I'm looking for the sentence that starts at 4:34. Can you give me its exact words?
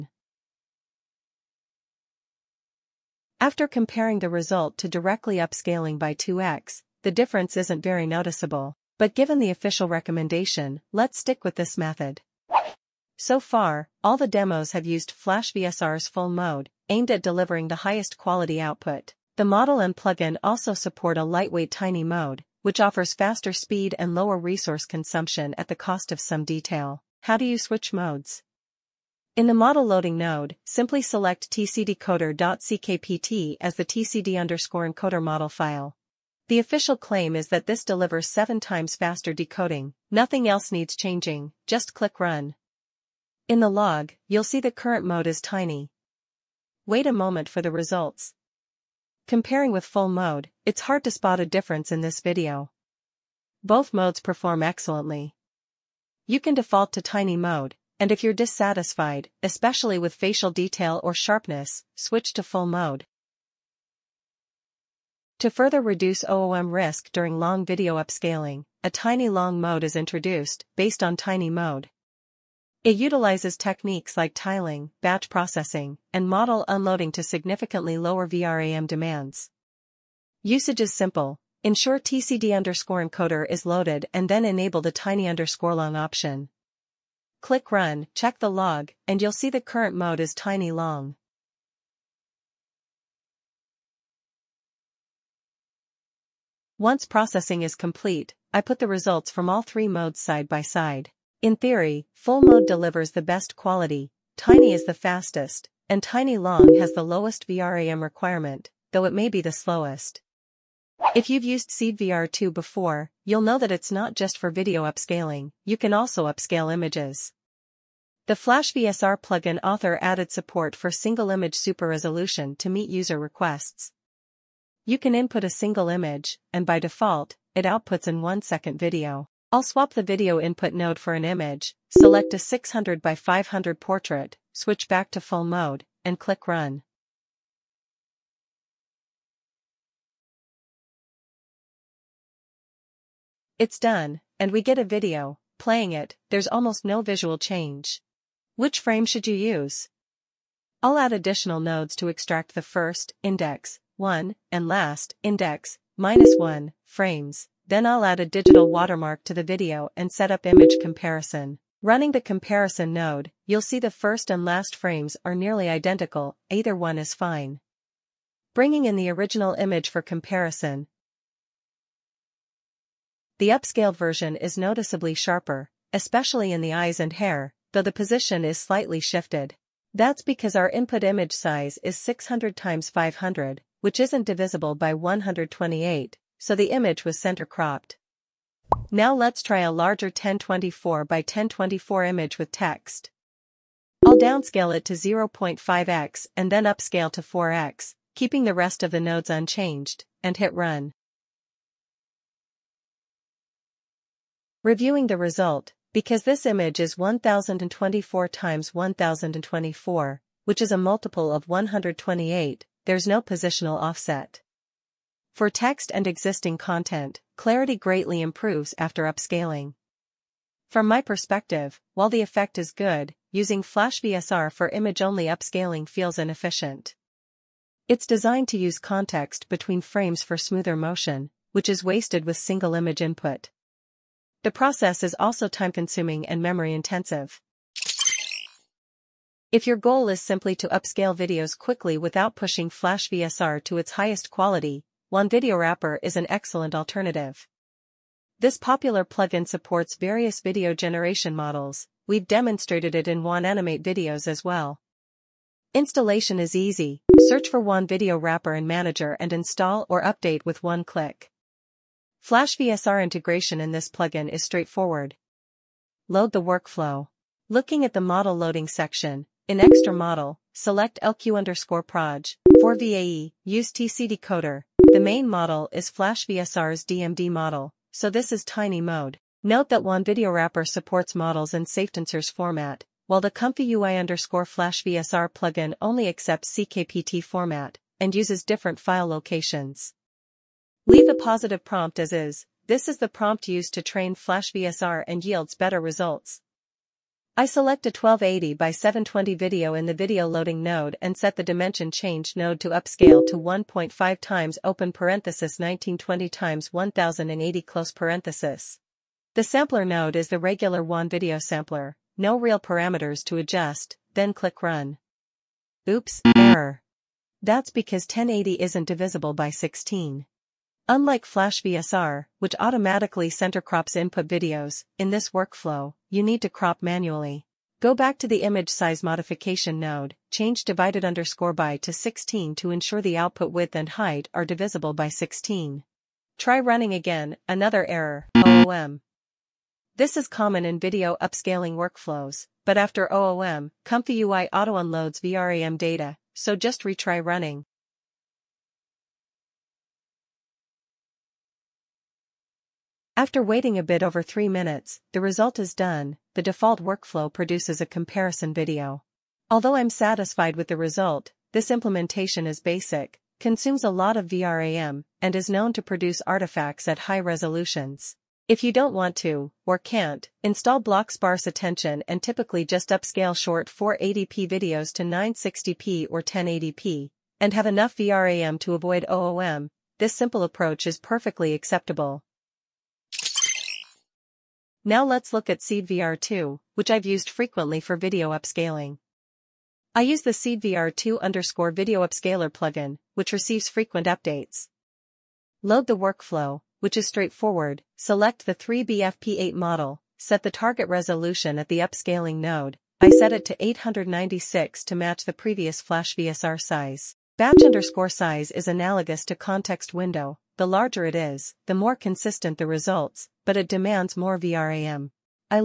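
The main model is Flash VSR's DMD model, so this is tiny mode.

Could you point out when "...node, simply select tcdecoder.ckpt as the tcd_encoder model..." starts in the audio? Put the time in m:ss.
0:30.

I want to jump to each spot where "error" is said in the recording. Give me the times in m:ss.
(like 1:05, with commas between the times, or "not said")
5:16, 5:37.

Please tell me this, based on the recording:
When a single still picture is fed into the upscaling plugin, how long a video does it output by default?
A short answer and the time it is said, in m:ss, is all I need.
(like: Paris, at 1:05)
1 second, at 2:08.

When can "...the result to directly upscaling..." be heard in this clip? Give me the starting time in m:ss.
0:04.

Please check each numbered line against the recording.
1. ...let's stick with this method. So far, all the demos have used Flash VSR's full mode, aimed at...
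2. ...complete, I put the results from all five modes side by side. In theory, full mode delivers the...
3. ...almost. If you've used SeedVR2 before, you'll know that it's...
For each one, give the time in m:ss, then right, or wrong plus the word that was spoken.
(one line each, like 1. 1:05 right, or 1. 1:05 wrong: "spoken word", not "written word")
1. 0:10 right
2. 1:37 wrong: "three", not "five"
3. 1:49 wrong: "slowest", not "almost".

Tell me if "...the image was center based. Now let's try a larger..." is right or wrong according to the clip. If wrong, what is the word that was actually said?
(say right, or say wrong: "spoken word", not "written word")
wrong: "cropped", not "based".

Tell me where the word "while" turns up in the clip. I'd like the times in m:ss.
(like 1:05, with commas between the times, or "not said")
3:41, 4:43.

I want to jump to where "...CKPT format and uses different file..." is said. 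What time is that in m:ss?
4:46.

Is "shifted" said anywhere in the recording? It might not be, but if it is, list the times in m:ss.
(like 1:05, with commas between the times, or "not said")
2:58.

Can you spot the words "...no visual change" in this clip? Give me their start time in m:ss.
2:26.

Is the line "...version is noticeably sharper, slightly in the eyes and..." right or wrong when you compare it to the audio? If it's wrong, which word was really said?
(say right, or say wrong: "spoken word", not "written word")
wrong: "especially", not "slightly".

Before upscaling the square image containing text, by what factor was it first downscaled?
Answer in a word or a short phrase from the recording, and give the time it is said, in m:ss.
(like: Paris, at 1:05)
0.5x, at 3:14.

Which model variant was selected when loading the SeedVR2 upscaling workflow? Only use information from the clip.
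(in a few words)
3B FP8.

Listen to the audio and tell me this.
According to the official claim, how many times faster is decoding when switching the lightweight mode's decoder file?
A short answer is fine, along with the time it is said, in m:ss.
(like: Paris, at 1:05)
7 times, at 0:38.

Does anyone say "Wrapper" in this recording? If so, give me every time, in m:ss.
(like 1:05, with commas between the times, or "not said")
4:05, 4:18, 4:40.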